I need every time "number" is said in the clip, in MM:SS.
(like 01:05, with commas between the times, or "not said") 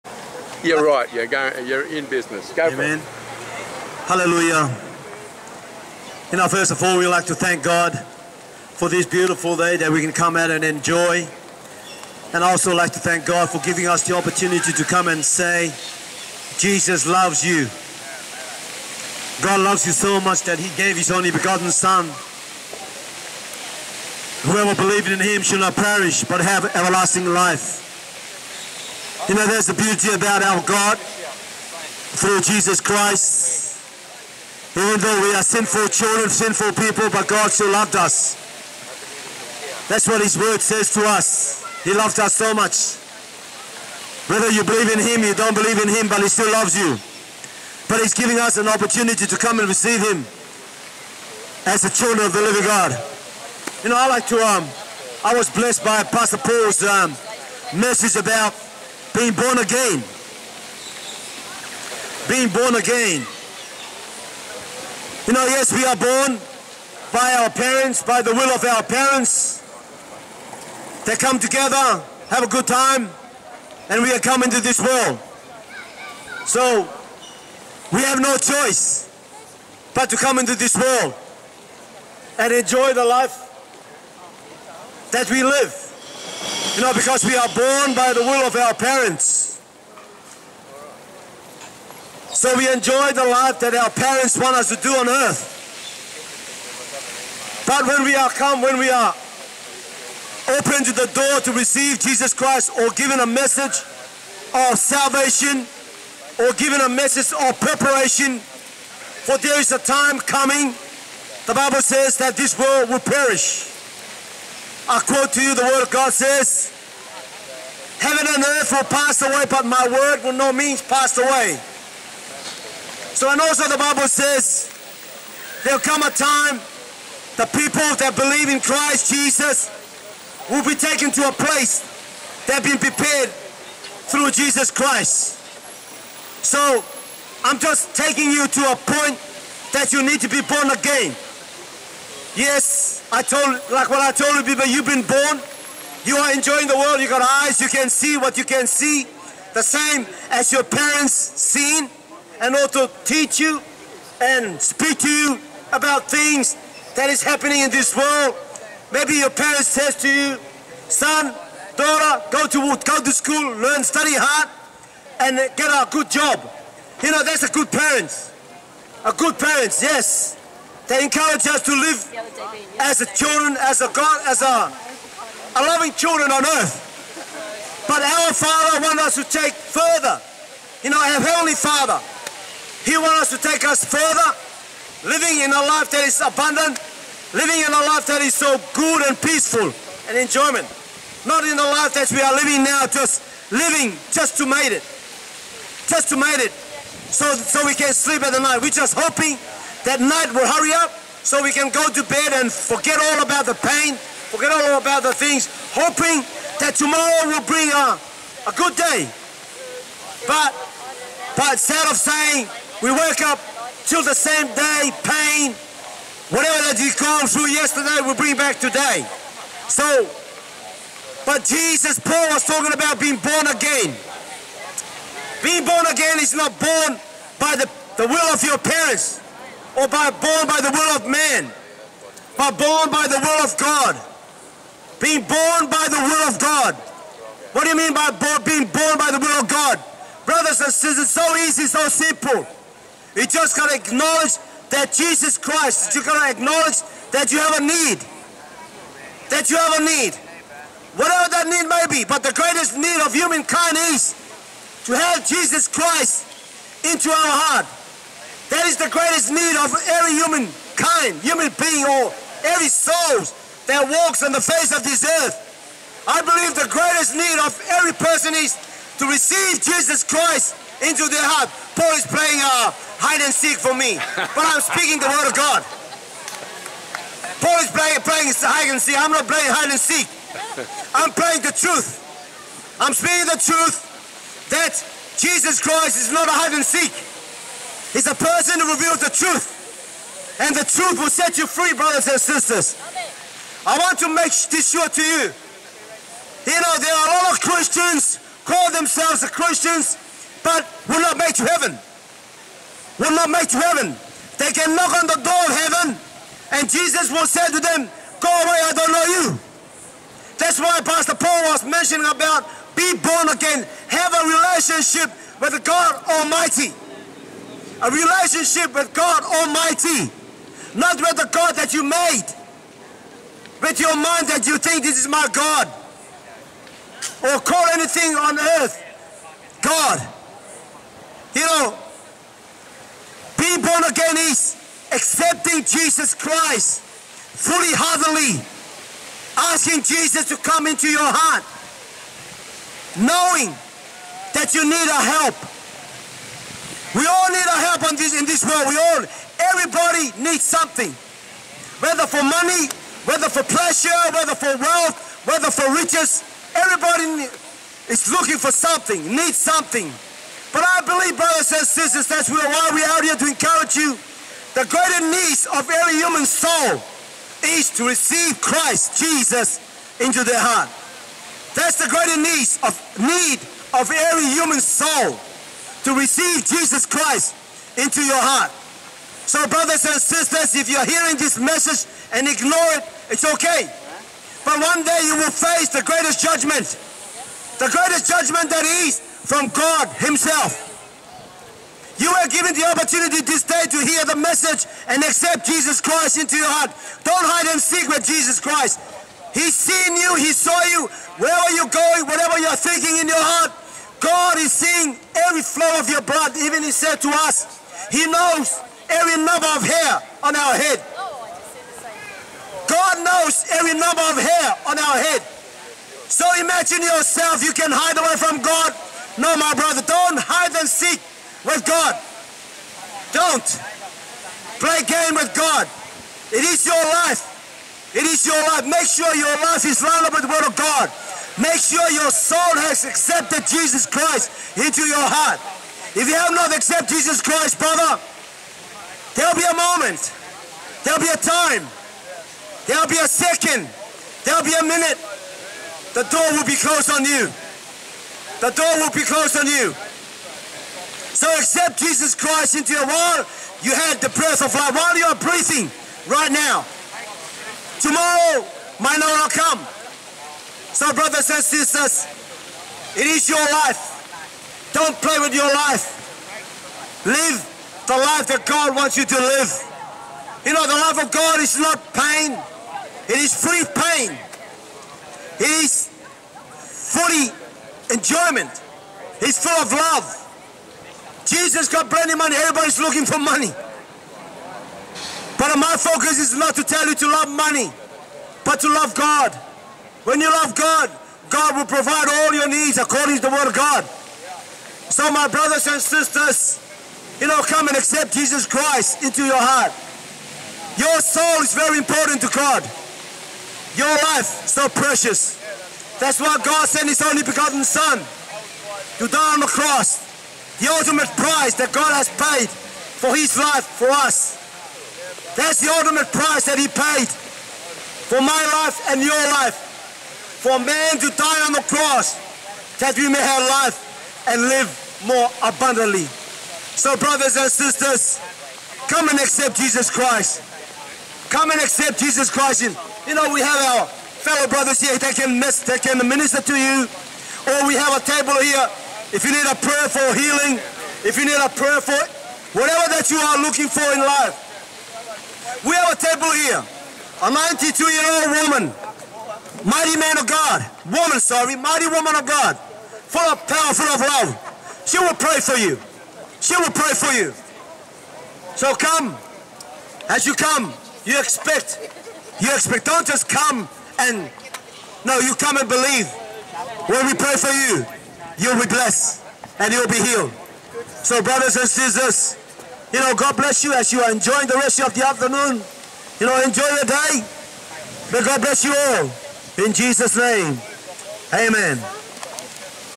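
06:49, 06:53.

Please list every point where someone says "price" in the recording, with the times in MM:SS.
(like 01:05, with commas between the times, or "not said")
08:31, 08:36.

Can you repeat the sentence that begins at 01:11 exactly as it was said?
They come together, have a good time, and we are coming to this world.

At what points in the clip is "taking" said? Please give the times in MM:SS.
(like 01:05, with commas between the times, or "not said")
02:17.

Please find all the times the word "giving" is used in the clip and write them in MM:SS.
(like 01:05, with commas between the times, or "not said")
00:13, 00:48.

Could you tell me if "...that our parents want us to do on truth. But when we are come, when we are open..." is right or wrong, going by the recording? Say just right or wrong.
wrong.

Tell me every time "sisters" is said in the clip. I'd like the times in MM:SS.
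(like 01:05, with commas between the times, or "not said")
04:00, 04:52, 06:01, 06:20, 07:41, 08:15, 08:47, 09:31.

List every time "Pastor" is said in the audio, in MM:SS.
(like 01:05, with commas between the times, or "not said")
00:56, 05:10.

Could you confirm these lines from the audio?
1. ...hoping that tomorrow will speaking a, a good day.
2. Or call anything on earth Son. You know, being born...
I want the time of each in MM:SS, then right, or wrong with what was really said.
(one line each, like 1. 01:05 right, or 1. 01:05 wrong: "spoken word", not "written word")
1. 03:25 wrong: "bring", not "speaking"
2. 05:27 wrong: "God", not "Son".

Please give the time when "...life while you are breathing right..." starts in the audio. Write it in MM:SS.
07:34.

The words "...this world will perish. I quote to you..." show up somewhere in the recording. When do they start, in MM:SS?
01:52.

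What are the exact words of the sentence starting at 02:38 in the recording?
Maybe your parents says to you, son, daughter, go to go to school, learn, study hard, and get a good job.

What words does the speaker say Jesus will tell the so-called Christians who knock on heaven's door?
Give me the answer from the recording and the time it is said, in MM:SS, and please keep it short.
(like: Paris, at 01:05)
Go away, at 05:08.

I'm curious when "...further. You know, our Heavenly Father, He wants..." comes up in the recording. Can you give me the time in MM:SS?
02:59.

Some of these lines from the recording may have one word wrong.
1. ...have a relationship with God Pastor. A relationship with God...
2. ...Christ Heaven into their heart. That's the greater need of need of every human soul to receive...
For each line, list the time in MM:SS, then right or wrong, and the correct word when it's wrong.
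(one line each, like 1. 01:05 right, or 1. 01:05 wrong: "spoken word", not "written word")
1. 05:13 wrong: "Almighty", not "Pastor"
2. 06:08 wrong: "Jesus", not "Heaven".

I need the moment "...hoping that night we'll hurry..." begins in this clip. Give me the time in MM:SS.
03:18.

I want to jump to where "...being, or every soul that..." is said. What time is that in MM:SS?
04:21.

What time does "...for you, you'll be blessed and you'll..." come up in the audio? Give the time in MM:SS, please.
09:27.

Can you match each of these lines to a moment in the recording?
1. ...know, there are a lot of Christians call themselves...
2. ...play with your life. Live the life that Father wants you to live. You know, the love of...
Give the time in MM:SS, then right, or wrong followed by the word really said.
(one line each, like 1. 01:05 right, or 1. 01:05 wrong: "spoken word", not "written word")
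1. 04:56 right
2. 07:45 wrong: "God", not "Father".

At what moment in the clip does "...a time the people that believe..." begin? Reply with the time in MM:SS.
02:06.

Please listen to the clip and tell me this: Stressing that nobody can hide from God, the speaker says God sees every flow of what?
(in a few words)
your blood.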